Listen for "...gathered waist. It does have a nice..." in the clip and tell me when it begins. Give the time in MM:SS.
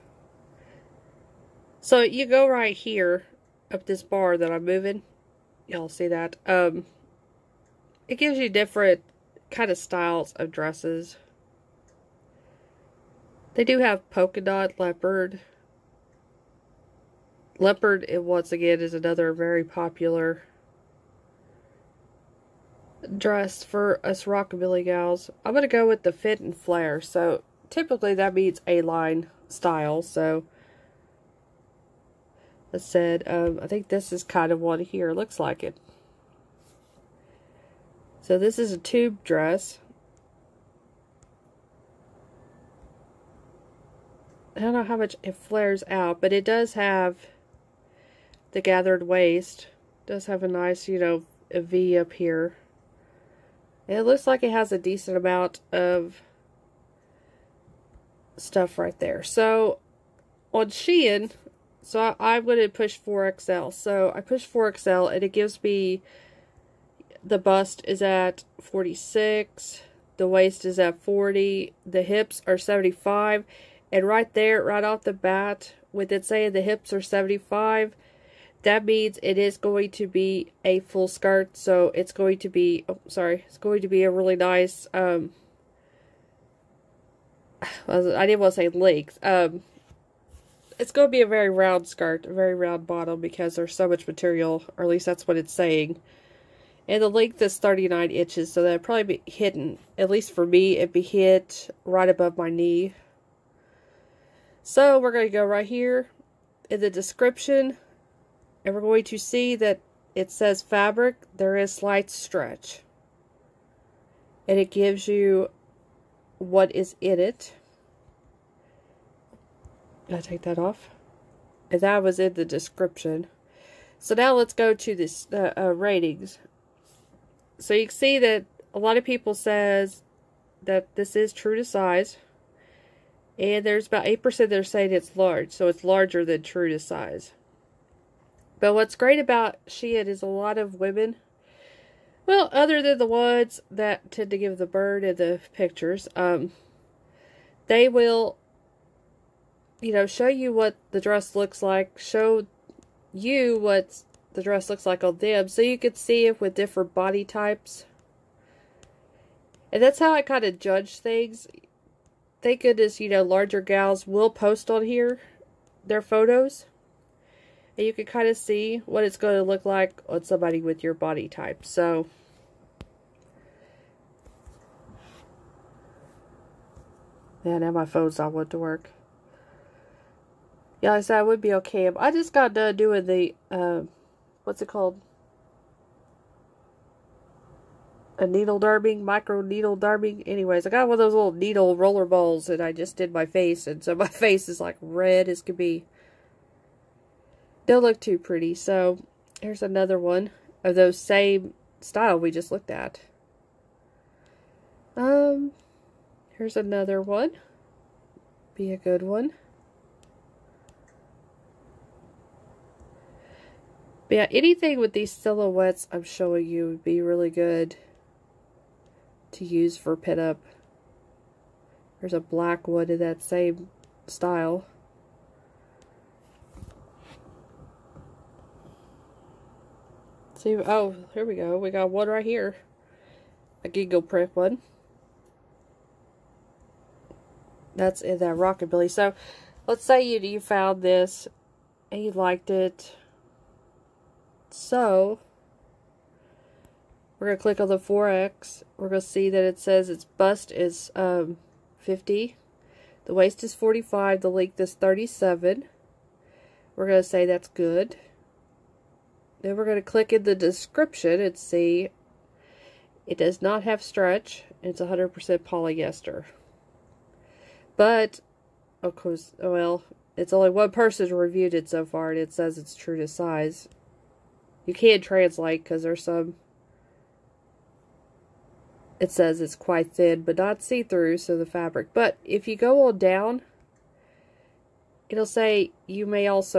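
00:48.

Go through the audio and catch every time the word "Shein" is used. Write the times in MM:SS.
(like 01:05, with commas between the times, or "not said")
01:00, 02:19.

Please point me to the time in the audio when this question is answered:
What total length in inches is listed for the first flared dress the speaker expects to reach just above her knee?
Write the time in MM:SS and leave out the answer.
01:37.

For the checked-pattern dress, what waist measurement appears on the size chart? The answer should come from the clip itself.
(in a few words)
45.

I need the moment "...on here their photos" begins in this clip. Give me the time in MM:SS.
02:44.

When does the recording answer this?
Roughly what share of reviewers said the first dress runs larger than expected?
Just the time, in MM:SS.
02:14.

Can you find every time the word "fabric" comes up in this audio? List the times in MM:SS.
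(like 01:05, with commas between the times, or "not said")
01:50, 04:41.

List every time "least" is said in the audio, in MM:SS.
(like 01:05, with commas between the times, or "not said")
01:34, 01:40.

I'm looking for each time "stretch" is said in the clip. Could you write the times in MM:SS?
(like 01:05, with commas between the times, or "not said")
01:52, 04:23.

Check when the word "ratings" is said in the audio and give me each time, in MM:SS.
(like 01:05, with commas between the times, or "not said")
02:05.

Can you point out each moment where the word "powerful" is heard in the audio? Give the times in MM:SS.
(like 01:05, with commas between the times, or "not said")
not said.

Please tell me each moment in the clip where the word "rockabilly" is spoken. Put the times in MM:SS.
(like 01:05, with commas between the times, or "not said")
00:24, 03:58.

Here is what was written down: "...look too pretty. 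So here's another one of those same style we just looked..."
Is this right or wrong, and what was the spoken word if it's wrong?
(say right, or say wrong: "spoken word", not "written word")
right.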